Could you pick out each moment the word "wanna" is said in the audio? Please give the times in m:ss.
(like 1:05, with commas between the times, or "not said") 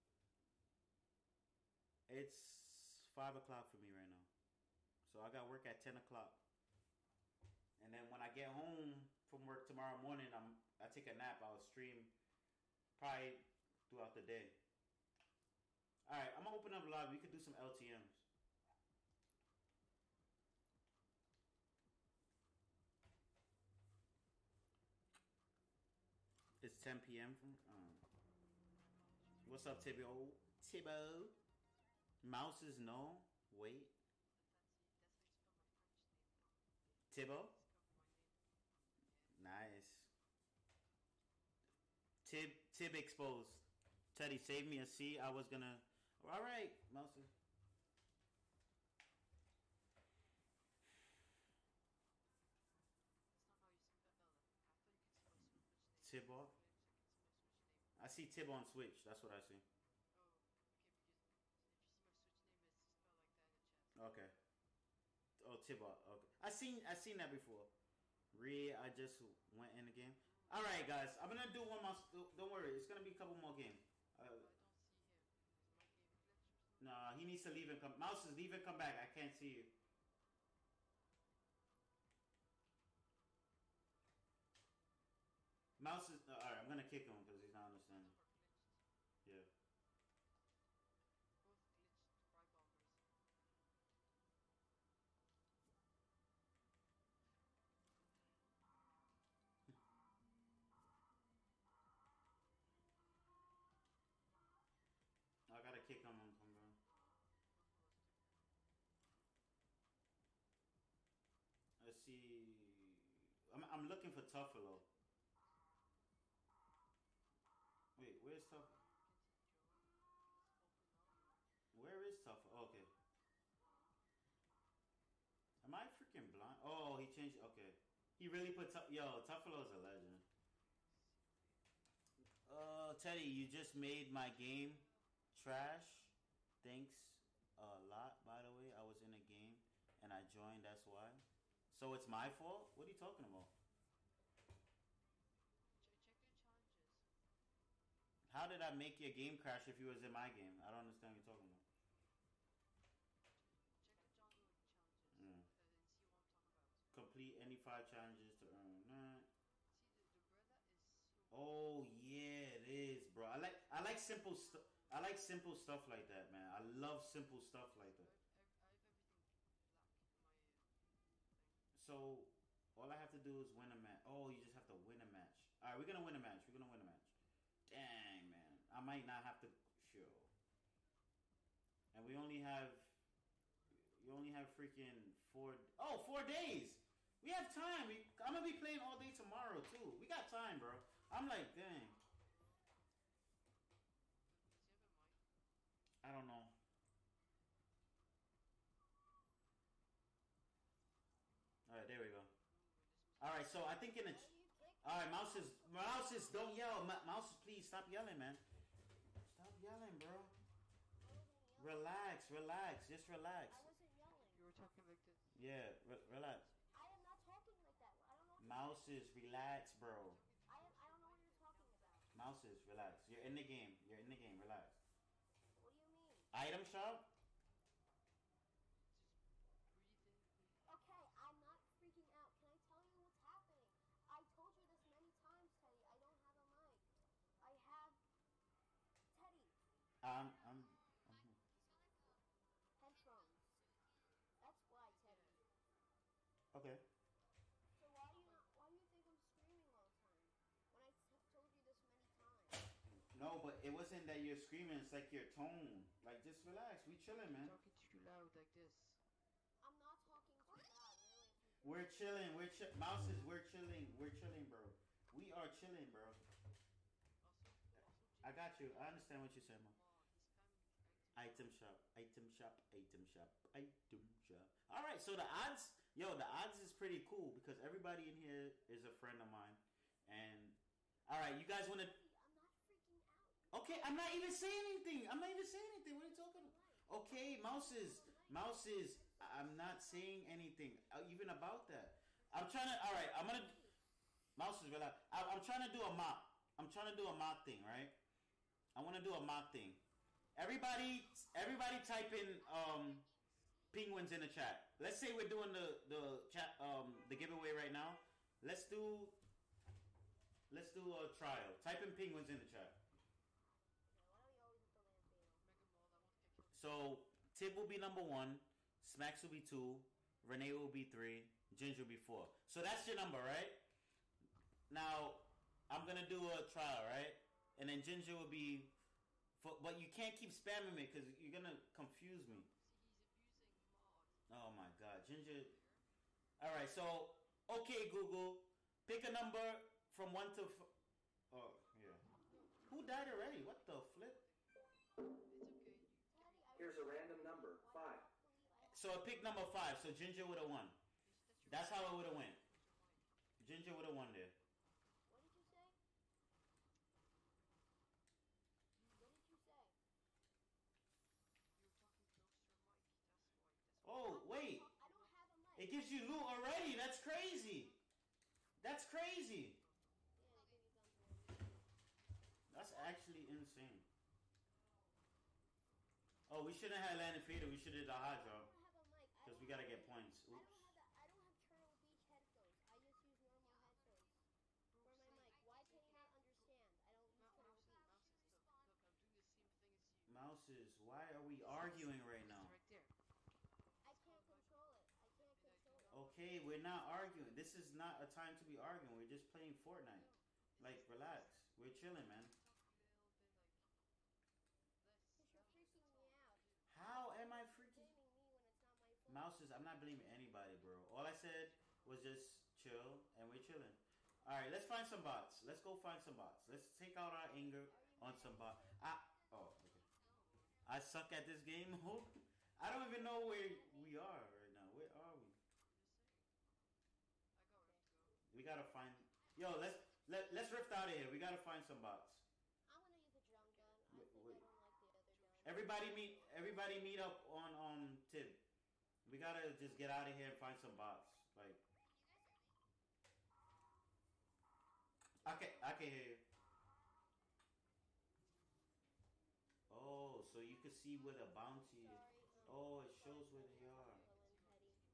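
7:12.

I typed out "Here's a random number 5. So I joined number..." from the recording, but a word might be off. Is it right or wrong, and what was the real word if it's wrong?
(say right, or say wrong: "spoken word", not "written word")
wrong: "picked", not "joined".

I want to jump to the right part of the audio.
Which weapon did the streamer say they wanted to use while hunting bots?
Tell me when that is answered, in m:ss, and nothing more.
7:13.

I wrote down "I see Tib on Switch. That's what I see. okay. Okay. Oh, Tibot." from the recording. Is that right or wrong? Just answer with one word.
right.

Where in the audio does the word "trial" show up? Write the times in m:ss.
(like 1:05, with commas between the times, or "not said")
5:11, 5:26.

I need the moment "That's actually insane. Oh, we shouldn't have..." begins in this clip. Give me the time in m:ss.
6:12.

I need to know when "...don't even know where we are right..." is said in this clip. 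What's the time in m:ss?
7:02.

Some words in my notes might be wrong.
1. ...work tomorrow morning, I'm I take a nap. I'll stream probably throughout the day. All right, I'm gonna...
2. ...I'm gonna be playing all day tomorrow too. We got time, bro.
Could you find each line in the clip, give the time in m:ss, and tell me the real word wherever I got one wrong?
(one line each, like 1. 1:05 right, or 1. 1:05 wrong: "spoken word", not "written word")
1. 0:09 right
2. 3:08 right.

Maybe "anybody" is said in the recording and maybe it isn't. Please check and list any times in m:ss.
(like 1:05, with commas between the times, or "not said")
6:50.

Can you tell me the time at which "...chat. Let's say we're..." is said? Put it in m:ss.
5:04.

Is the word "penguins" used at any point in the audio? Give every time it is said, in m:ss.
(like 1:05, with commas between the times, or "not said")
5:03, 5:11.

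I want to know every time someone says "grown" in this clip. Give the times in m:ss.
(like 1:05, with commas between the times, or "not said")
not said.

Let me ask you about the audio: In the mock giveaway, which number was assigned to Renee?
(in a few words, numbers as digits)
3.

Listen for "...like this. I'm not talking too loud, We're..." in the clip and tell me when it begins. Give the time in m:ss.
4:18.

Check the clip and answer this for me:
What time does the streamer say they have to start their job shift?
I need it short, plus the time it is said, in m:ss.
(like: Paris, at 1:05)
10 o'clock, at 0:05.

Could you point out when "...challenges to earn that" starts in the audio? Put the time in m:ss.
2:37.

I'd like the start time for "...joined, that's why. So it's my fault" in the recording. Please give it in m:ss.
2:20.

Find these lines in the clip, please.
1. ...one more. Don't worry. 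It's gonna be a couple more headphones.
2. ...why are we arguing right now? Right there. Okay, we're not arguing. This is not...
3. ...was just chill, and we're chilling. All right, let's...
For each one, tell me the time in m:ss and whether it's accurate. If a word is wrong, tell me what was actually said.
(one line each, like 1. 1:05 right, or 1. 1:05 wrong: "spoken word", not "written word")
1. 1:11 wrong: "games", not "headphones"
2. 6:30 right
3. 6:51 right.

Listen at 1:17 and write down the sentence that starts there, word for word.
Mouse is leave and come back.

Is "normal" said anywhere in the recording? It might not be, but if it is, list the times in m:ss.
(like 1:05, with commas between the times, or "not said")
6:23.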